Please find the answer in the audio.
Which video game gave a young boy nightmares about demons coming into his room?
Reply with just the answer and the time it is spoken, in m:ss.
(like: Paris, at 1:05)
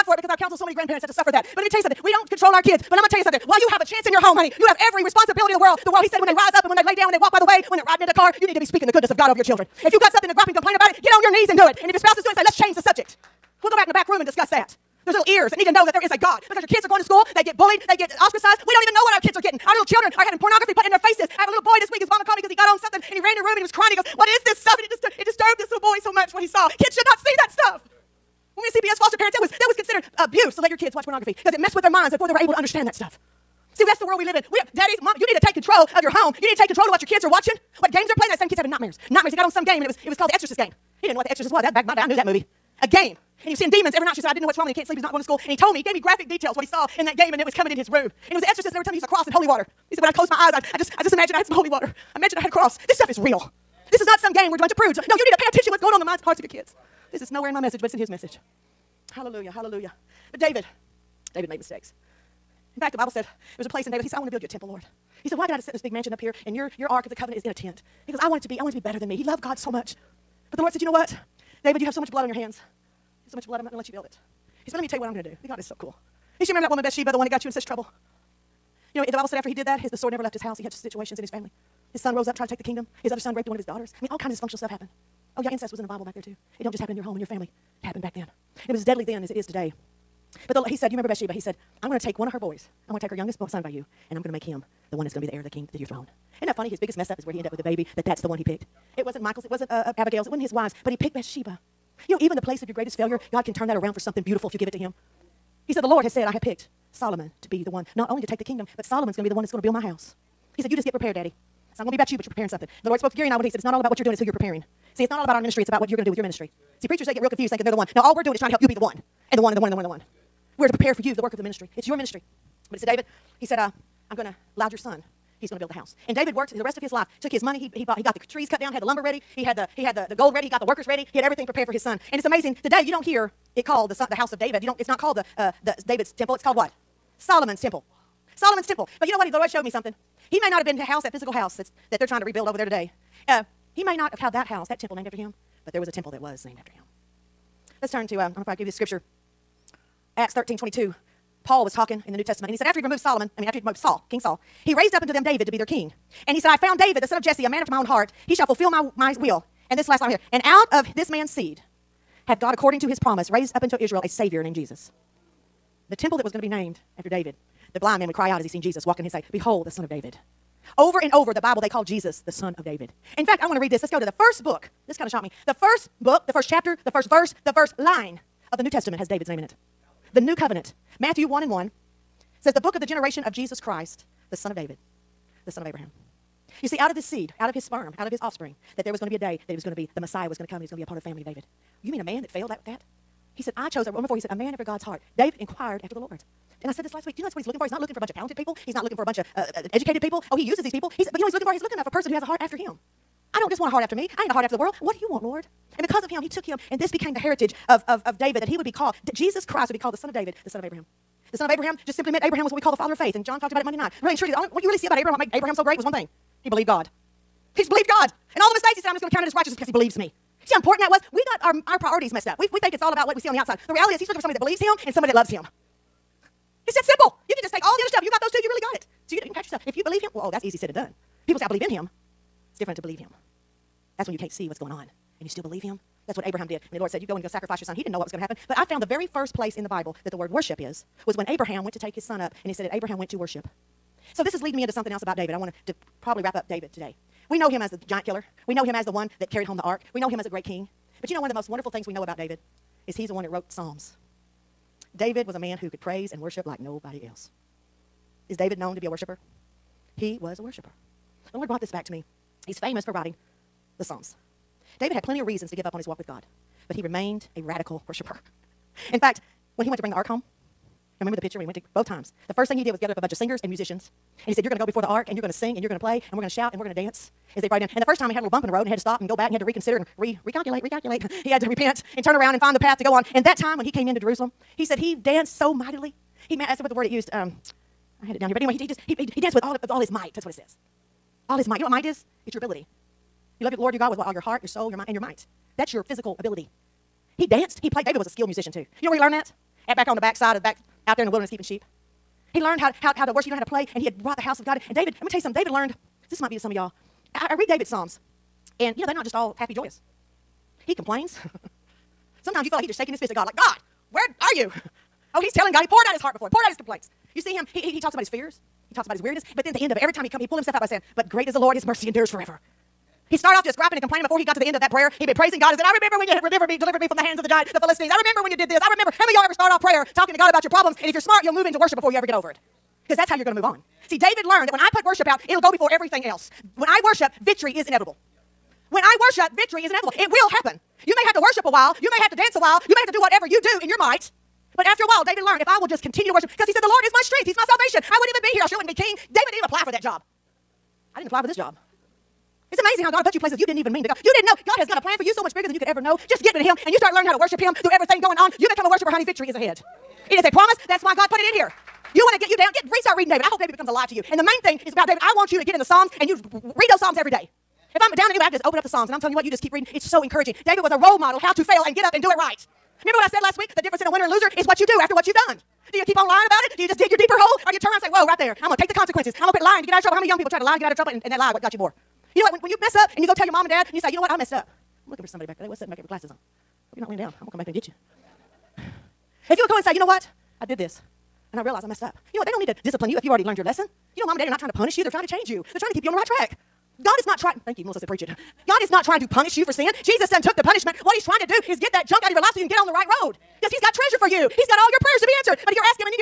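The Exorcist game, at 0:40.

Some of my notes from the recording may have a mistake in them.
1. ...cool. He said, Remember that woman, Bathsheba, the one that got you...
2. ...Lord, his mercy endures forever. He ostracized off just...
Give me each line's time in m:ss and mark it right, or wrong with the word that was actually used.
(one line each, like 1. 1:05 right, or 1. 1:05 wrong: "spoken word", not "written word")
1. 1:15 right
2. 5:21 wrong: "started", not "ostracized".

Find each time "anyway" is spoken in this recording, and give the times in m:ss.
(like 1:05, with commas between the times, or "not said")
4:48, 6:08.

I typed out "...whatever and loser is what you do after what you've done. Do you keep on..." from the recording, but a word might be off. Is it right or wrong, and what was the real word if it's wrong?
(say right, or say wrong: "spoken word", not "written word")
wrong: "winner", not "whatever".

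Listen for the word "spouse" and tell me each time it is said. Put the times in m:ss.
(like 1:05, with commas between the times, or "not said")
0:11.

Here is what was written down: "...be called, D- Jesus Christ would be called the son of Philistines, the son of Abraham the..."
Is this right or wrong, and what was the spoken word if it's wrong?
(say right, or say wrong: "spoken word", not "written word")
wrong: "David", not "Philistines".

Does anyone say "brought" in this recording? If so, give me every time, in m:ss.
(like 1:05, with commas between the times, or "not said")
4:21, 4:37, 5:04.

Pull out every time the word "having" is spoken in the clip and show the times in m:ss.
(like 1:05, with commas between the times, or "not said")
0:20, 0:38.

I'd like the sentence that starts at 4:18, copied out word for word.
Is David known to be a worshiper?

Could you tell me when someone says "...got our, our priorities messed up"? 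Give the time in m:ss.
3:41.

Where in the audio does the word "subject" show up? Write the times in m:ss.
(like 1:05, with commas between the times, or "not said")
0:12.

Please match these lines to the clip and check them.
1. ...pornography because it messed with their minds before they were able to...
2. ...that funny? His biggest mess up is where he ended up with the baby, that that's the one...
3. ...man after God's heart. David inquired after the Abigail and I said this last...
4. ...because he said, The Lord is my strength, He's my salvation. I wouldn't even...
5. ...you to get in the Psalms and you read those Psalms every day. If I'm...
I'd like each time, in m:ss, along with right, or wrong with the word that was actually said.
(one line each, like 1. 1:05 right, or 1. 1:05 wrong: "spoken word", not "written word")
1. 0:31 right
2. 1:36 right
3. 3:14 wrong: "Lord", not "Abigail"
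4. 5:46 right
5. 6:05 right.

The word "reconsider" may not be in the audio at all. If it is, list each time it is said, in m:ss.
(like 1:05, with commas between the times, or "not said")
4:39.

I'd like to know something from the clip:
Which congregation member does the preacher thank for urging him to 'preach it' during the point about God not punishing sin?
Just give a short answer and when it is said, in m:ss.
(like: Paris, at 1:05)
Melissa, at 6:37.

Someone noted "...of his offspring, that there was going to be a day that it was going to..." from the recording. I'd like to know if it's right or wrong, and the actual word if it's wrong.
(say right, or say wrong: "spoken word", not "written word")
right.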